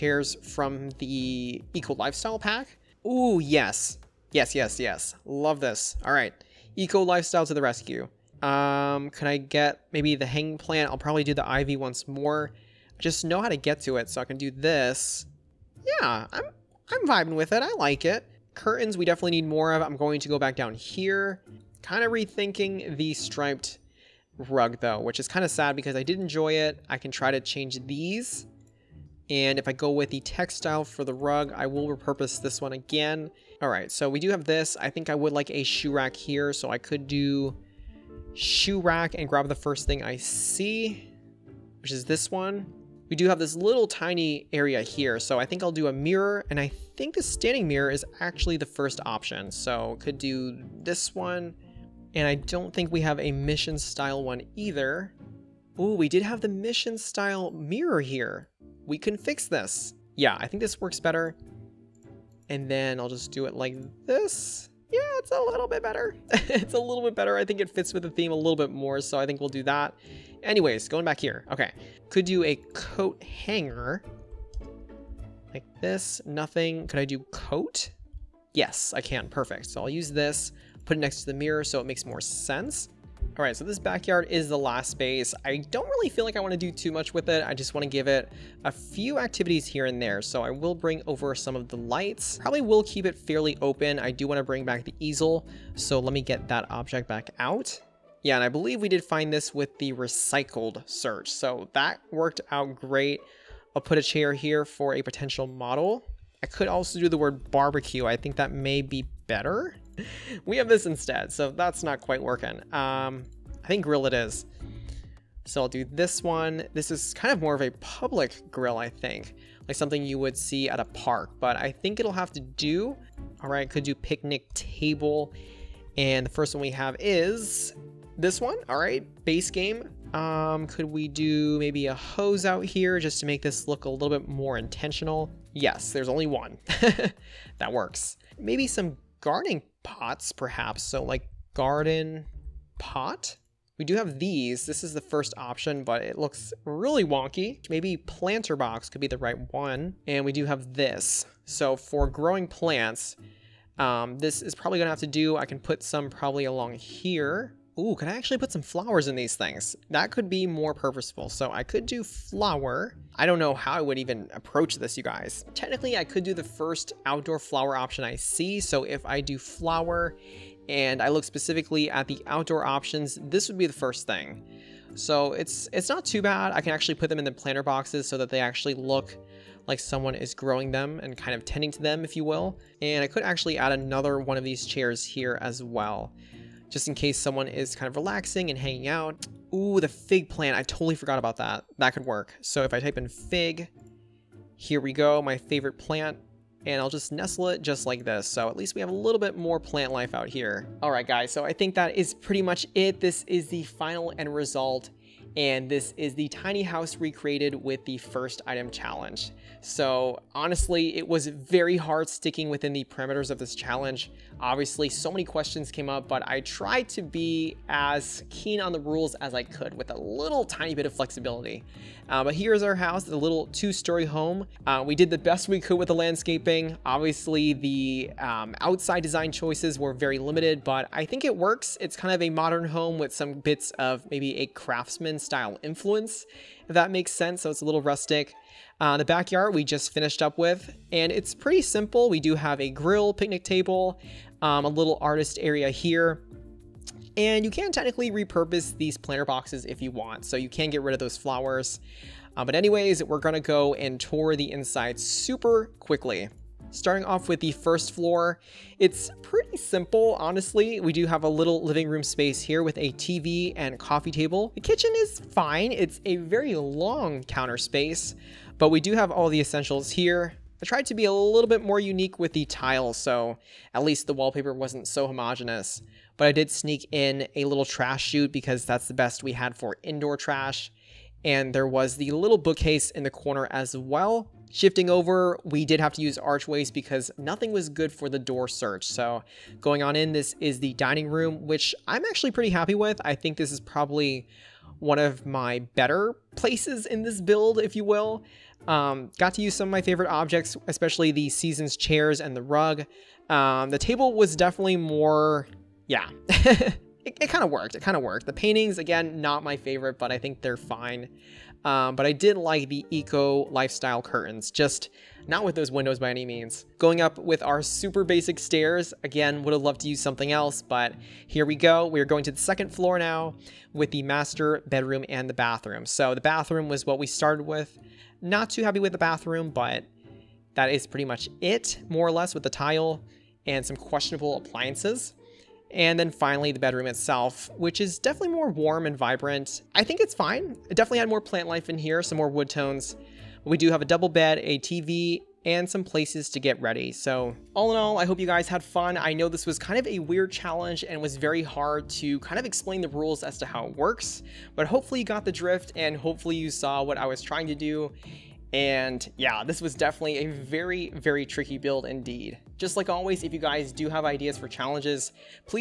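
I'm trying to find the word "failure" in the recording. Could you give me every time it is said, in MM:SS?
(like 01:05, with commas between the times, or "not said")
not said.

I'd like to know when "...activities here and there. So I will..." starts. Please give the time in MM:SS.
01:29.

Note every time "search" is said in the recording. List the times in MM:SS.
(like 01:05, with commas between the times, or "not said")
01:40, 04:48.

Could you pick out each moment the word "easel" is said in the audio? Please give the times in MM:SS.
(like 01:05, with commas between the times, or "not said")
01:34.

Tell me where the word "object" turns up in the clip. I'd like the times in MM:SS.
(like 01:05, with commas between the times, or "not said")
01:36, 05:00.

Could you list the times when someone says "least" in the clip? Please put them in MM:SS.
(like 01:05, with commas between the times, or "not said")
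03:18, 04:33.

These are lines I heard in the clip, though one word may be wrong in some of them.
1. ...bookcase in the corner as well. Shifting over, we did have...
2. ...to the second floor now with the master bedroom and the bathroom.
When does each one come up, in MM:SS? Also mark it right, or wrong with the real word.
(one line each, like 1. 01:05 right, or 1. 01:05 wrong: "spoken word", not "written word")
1. 04:42 right
2. 05:22 right.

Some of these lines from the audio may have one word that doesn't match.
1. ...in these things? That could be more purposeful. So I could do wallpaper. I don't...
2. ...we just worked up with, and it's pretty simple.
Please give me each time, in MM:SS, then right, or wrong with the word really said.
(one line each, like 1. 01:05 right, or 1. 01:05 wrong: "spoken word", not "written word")
1. 02:39 wrong: "flower", not "wallpaper"
2. 03:59 wrong: "finished", not "worked".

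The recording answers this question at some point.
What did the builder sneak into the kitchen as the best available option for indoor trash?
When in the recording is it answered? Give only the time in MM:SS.
04:37.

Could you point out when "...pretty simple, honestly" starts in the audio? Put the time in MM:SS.
04:19.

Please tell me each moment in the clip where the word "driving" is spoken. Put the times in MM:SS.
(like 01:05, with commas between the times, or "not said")
not said.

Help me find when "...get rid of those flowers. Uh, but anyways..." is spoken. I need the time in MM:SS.
04:10.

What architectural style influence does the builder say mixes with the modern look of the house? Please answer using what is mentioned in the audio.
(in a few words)
craftsman.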